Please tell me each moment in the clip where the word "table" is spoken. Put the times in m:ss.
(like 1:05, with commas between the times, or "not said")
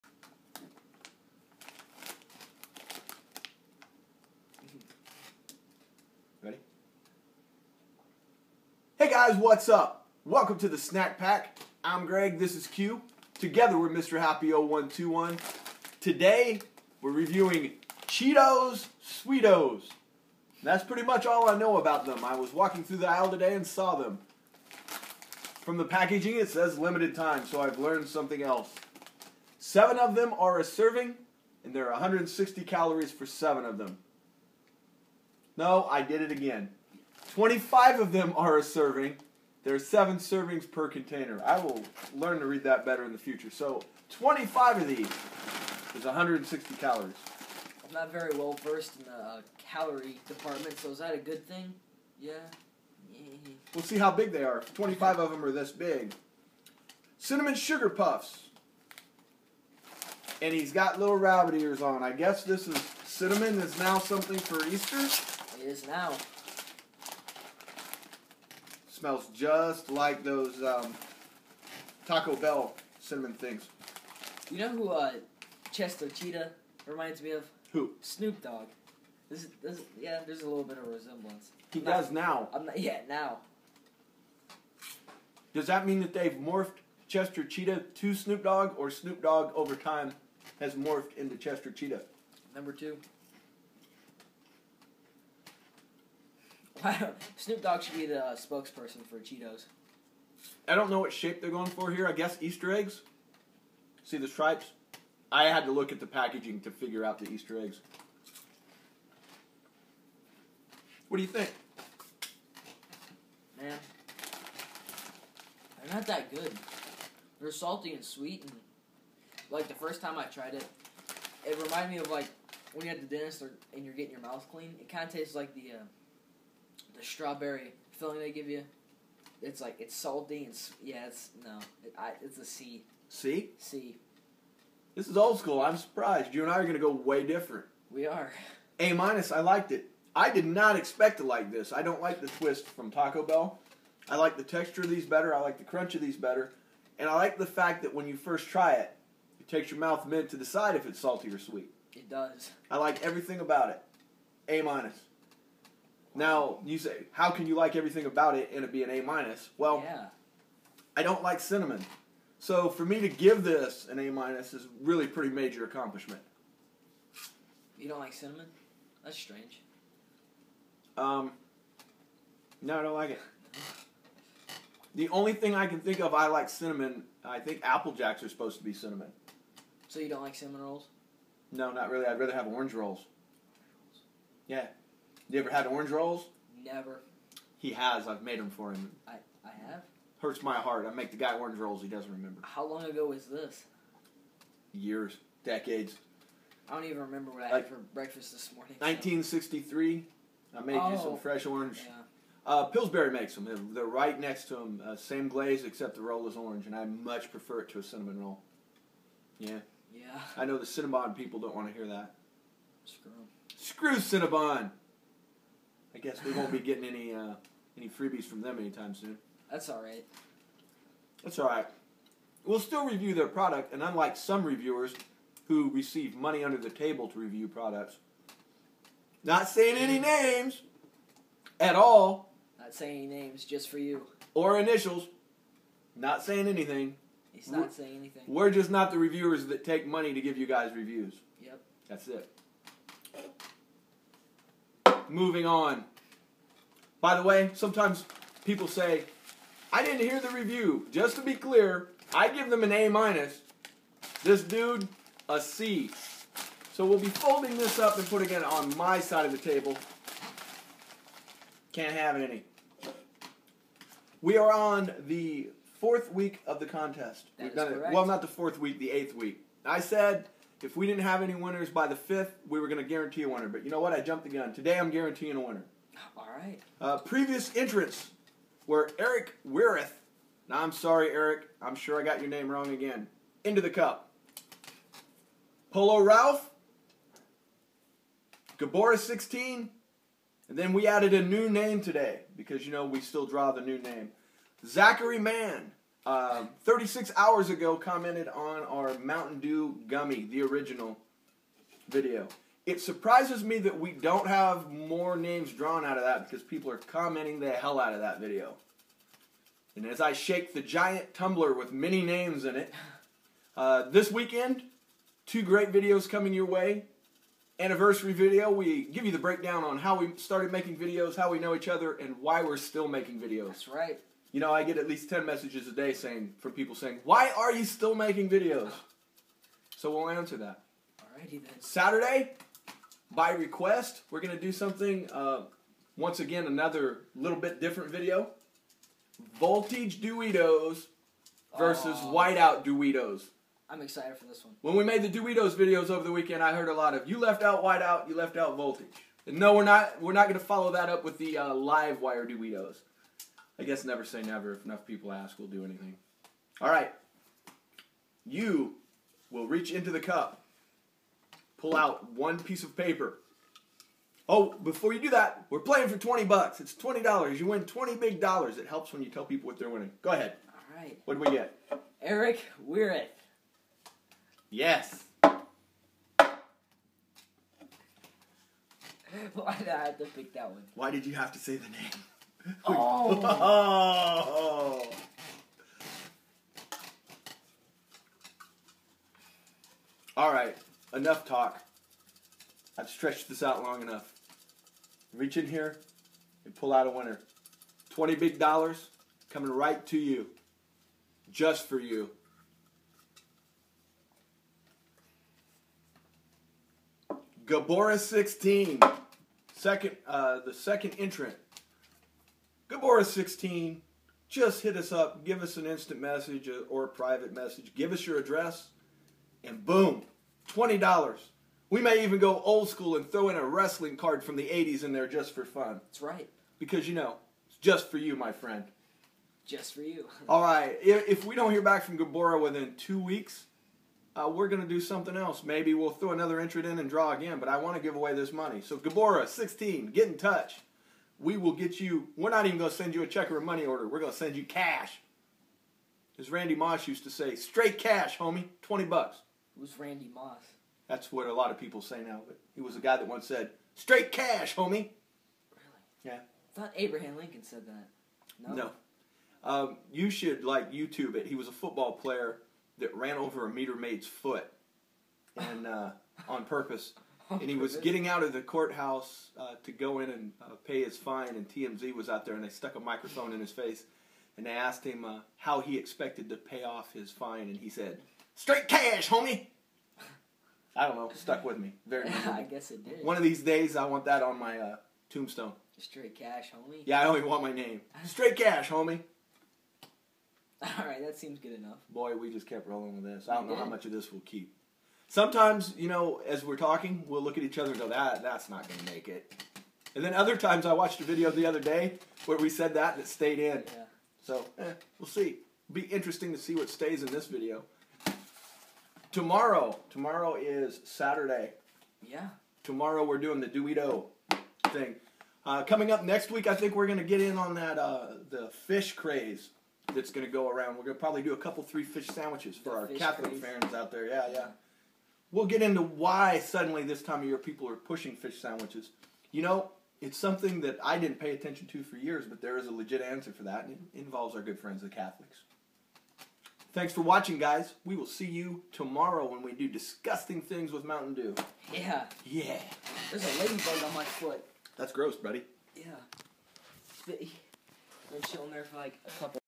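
3:46, 4:19.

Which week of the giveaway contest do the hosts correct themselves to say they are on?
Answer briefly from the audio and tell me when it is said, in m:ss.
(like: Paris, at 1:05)
eighth week, at 4:28.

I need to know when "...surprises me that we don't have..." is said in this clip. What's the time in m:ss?
5:02.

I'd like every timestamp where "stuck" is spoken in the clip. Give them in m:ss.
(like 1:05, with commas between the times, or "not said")
7:52, 8:01.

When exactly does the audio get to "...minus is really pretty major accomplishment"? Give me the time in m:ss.
2:44.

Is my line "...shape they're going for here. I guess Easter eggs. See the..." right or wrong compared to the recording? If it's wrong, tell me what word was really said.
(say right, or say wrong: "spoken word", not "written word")
right.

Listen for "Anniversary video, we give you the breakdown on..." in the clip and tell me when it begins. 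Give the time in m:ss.
5:17.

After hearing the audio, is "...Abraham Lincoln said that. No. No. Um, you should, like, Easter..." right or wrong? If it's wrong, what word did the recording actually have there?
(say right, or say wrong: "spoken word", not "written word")
wrong: "YouTube", not "Easter".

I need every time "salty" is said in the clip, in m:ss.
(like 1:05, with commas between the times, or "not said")
1:57, 2:09, 2:30.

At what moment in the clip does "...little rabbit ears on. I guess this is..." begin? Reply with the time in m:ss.
1:00.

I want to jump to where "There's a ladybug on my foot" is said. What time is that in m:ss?
9:03.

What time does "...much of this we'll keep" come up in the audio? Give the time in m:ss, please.
8:13.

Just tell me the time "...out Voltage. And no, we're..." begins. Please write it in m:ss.
5:48.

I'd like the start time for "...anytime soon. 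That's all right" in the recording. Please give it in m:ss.
3:38.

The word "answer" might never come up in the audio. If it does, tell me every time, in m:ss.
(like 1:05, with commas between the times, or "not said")
5:30, 8:53.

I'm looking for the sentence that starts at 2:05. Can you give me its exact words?
Uh, the strawberry filling they give you.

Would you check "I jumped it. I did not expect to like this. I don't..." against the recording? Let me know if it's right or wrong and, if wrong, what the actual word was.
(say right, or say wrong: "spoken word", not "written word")
wrong: "liked", not "jumped".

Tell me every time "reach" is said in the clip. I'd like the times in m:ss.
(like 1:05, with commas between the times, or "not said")
5:59, 6:35.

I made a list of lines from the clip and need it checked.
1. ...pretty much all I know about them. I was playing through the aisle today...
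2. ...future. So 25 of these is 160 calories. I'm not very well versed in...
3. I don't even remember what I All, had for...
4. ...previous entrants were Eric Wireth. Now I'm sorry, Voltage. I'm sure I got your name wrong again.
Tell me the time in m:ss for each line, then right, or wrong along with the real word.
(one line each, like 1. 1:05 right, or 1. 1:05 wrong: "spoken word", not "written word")
1. 0:20 wrong: "walking", not "playing"
2. 0:43 right
3. 3:16 wrong: "Like", not "All"
4. 4:36 wrong: "Eric", not "Voltage".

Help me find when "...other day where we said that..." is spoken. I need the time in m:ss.
8:21.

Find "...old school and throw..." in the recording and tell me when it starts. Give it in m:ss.
7:02.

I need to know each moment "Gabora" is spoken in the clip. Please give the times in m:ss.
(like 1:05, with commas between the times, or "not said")
4:48, 6:47, 7:11, 7:18.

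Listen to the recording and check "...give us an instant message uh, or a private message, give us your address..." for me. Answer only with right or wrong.
right.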